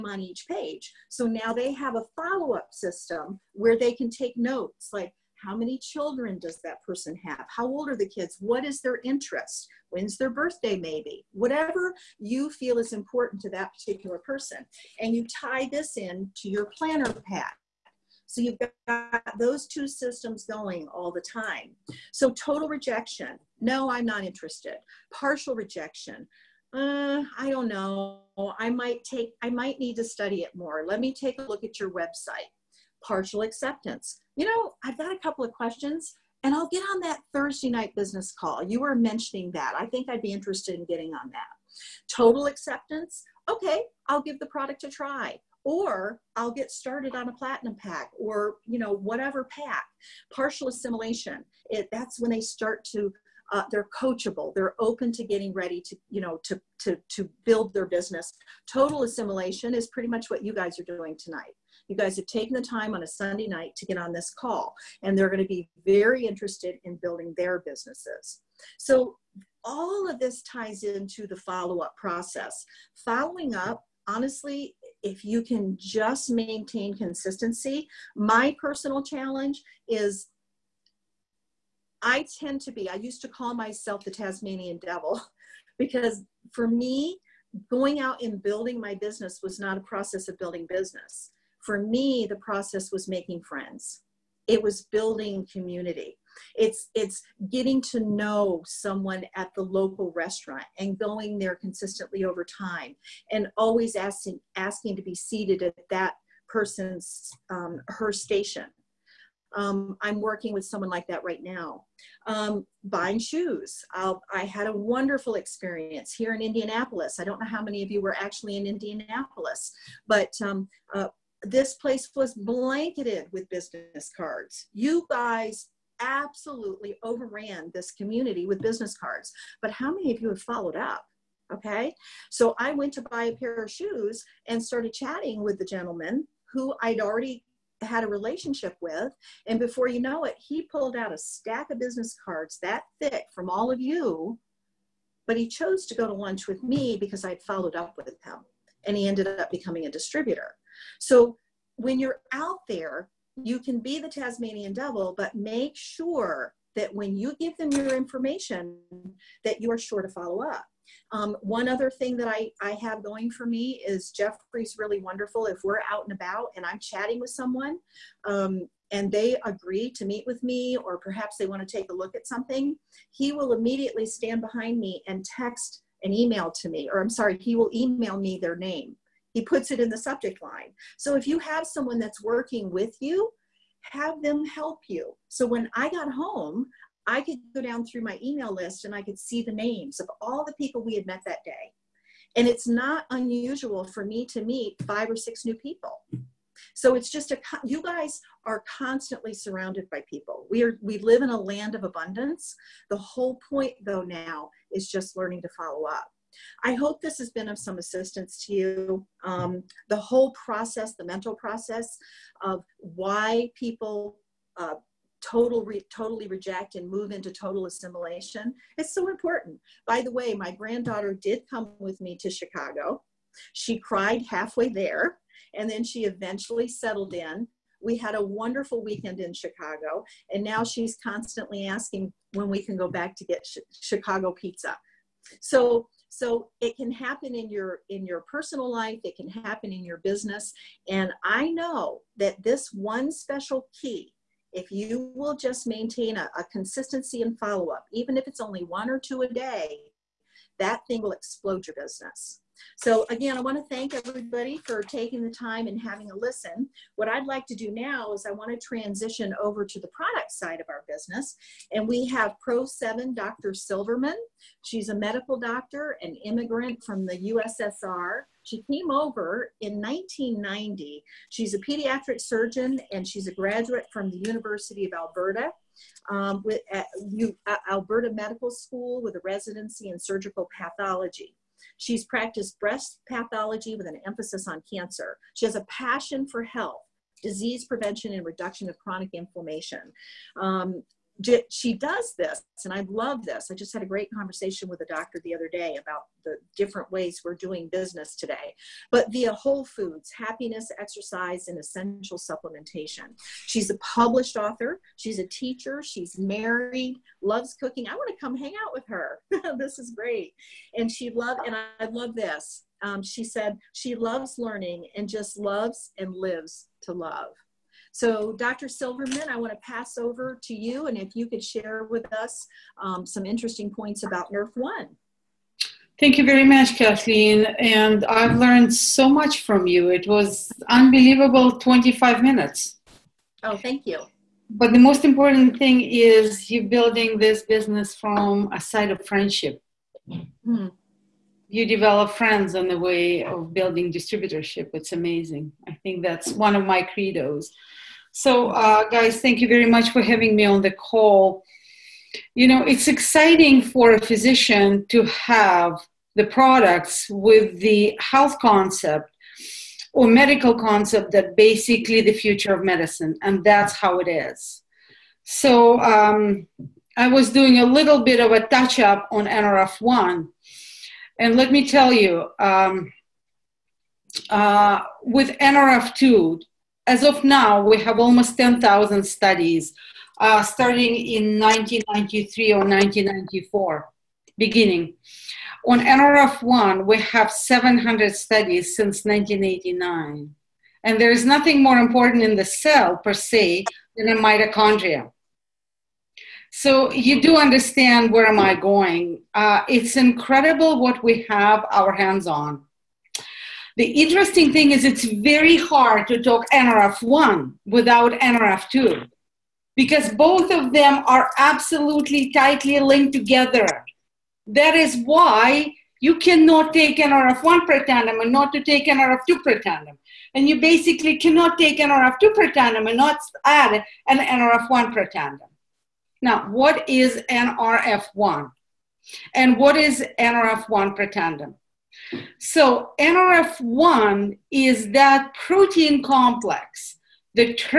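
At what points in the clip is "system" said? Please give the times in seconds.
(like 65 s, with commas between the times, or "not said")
2 s, 19 s.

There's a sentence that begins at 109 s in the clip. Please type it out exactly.
Um, I'm working with someone like that right now.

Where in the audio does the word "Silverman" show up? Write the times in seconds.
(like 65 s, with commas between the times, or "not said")
263 s, 318 s.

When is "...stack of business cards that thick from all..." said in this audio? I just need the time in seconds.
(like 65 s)
141 s.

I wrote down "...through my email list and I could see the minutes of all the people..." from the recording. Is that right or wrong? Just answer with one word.
wrong.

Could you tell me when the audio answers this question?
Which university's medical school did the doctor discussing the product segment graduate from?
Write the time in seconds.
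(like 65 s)
274 s.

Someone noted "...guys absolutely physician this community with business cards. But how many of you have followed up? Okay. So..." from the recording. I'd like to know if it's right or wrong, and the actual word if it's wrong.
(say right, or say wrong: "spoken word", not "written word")
wrong: "overran", not "physician".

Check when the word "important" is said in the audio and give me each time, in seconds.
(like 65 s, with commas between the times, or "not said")
12 s, 219 s, 335 s, 391 s.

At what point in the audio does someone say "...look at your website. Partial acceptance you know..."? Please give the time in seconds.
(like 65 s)
31 s.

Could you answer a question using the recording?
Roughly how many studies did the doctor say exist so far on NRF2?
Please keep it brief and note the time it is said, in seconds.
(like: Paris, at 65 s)
10,000, at 378 s.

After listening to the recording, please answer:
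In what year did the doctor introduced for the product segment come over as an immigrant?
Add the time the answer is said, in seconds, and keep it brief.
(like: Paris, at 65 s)
1990, at 269 s.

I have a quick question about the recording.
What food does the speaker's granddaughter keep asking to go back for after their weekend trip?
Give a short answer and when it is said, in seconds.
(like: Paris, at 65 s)
Chicago pizza, at 233 s.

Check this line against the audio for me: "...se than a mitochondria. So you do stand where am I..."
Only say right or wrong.
wrong.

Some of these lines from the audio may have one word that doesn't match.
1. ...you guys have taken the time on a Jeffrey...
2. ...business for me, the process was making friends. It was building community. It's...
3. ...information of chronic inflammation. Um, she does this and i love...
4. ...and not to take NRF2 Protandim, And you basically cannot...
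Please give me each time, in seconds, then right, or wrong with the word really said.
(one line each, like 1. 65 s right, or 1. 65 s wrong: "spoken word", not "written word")
1. 61 s wrong: "Sunday", not "Jeffrey"
2. 90 s right
3. 288 s wrong: "reduction", not "information"
4. 418 s right.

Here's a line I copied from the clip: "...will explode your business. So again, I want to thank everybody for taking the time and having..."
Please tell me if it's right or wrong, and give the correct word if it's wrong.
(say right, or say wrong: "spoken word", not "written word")
right.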